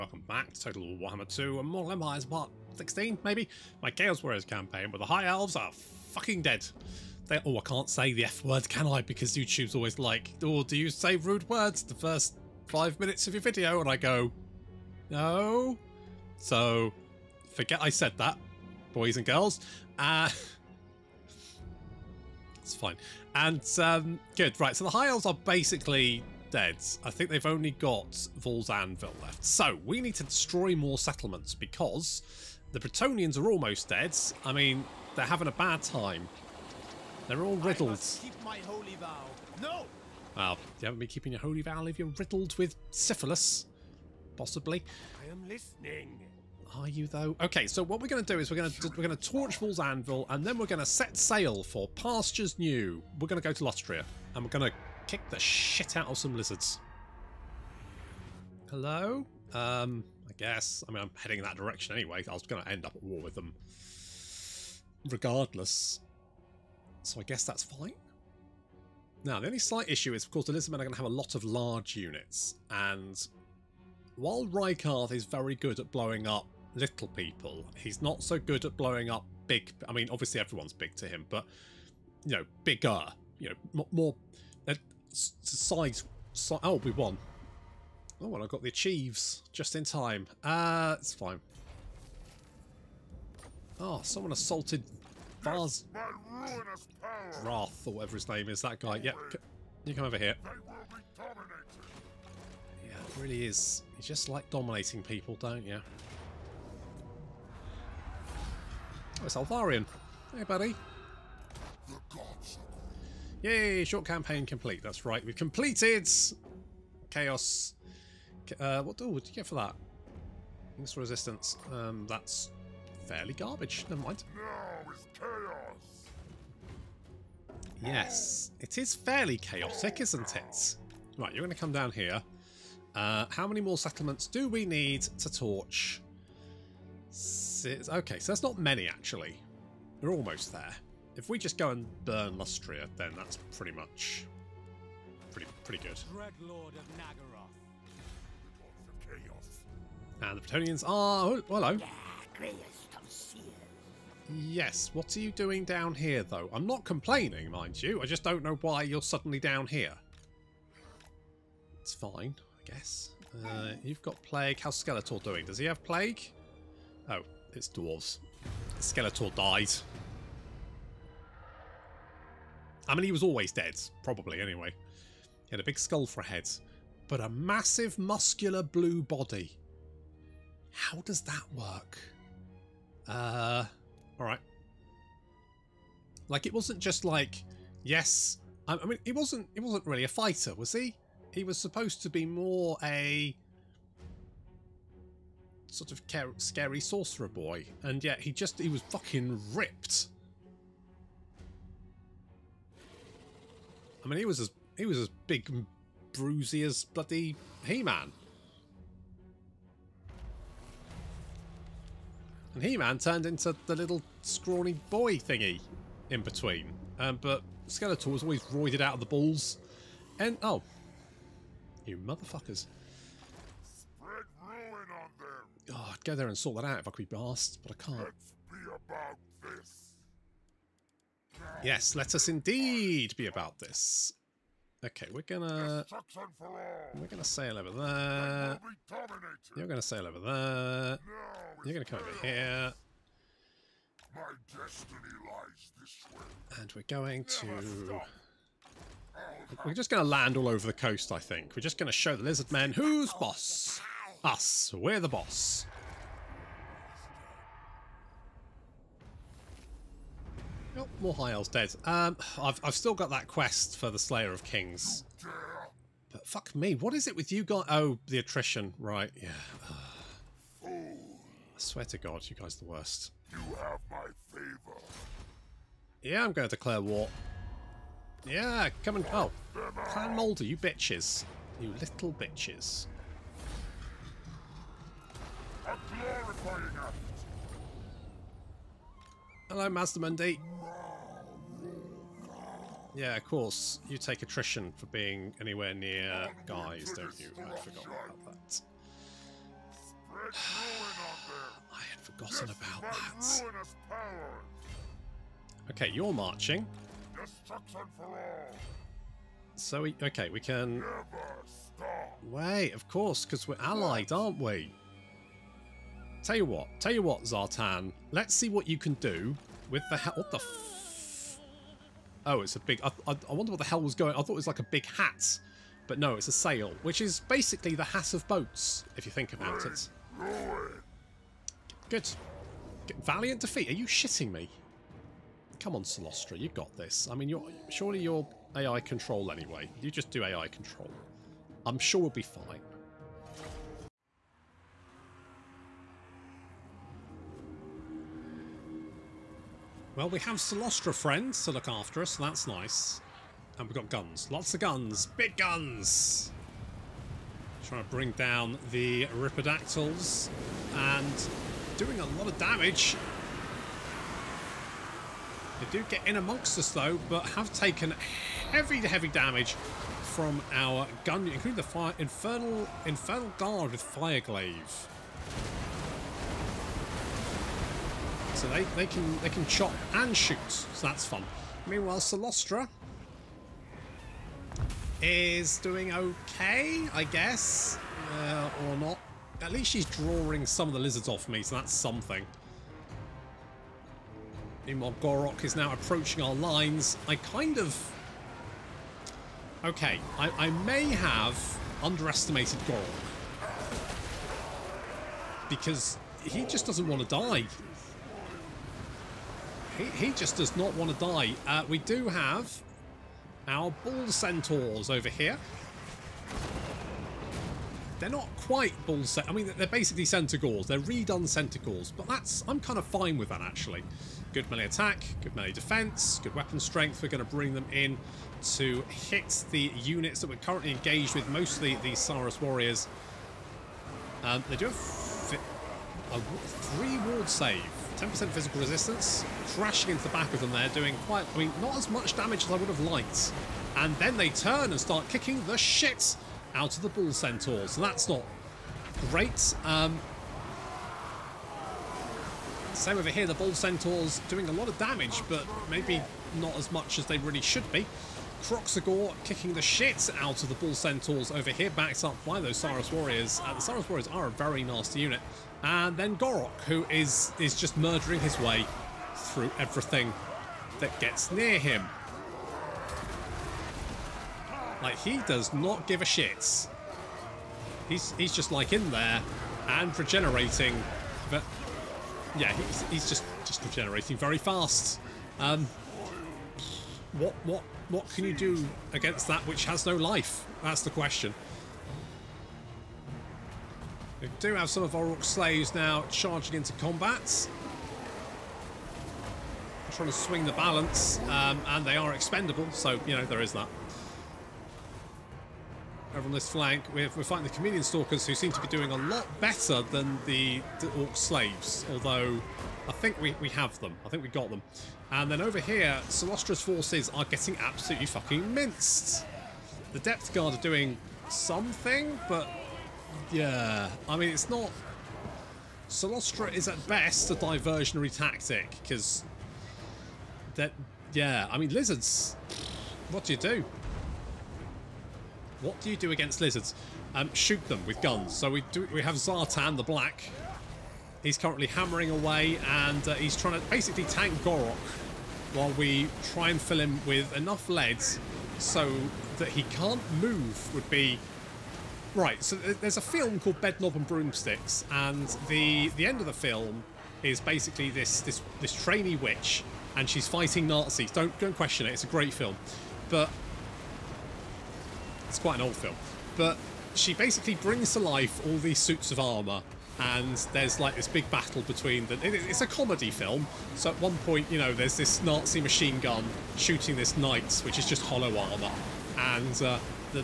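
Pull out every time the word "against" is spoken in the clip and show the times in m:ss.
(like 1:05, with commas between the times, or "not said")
8:08, 8:56.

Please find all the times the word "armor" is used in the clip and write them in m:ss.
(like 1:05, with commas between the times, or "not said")
9:29, 9:38.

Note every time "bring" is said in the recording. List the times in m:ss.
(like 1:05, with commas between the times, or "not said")
5:57, 7:07, 9:27.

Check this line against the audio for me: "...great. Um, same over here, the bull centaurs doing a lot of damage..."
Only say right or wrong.
right.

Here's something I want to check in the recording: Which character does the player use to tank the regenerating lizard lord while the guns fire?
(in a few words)
Zhatan the Black.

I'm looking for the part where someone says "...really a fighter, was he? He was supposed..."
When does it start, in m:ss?
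3:09.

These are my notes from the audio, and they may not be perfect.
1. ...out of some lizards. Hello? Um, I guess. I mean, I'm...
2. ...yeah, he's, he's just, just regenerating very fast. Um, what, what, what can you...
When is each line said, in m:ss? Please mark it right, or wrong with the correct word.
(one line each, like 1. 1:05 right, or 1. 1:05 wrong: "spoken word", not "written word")
1. 0:55 right
2. 8:02 right.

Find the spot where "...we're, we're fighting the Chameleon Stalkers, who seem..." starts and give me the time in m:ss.
8:26.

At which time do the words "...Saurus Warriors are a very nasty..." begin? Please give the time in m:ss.
7:43.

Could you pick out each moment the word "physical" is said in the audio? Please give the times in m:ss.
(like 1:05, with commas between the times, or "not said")
7:18.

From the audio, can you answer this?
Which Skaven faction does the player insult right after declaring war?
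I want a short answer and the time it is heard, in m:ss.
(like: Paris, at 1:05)
Clan Moulder, at 4:39.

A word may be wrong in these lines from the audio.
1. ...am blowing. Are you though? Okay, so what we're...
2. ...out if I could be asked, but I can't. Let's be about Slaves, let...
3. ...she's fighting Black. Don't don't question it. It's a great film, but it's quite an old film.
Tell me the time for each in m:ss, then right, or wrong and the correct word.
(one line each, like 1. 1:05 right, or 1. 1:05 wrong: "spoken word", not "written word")
1. 0:45 wrong: "listening", not "blowing"
2. 3:46 wrong: "Yes", not "Slaves"
3. 9:20 wrong: "Nazis", not "Black".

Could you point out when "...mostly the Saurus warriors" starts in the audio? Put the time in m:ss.
7:11.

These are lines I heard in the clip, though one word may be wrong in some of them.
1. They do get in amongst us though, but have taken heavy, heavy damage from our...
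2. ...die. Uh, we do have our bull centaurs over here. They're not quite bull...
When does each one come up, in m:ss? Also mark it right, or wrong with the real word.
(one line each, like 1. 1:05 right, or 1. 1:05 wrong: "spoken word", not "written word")
1. 6:05 right
2. 6:51 right.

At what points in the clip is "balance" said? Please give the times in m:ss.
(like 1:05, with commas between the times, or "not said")
8:20.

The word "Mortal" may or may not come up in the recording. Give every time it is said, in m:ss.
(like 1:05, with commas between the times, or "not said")
0:01.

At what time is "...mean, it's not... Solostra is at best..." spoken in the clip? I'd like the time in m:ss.
8:44.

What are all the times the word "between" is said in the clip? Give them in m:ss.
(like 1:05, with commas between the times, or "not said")
3:36, 9:31.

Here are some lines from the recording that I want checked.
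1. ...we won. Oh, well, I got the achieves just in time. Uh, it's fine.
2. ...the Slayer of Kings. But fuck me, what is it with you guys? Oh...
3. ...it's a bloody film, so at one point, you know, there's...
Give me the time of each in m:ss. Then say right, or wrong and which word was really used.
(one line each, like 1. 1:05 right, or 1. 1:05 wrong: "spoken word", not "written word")
1. 1:26 right
2. 4:23 right
3. 9:32 wrong: "comedy", not "bloody".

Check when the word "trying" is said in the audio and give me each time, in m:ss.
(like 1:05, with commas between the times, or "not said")
5:57, 8:19, 9:03.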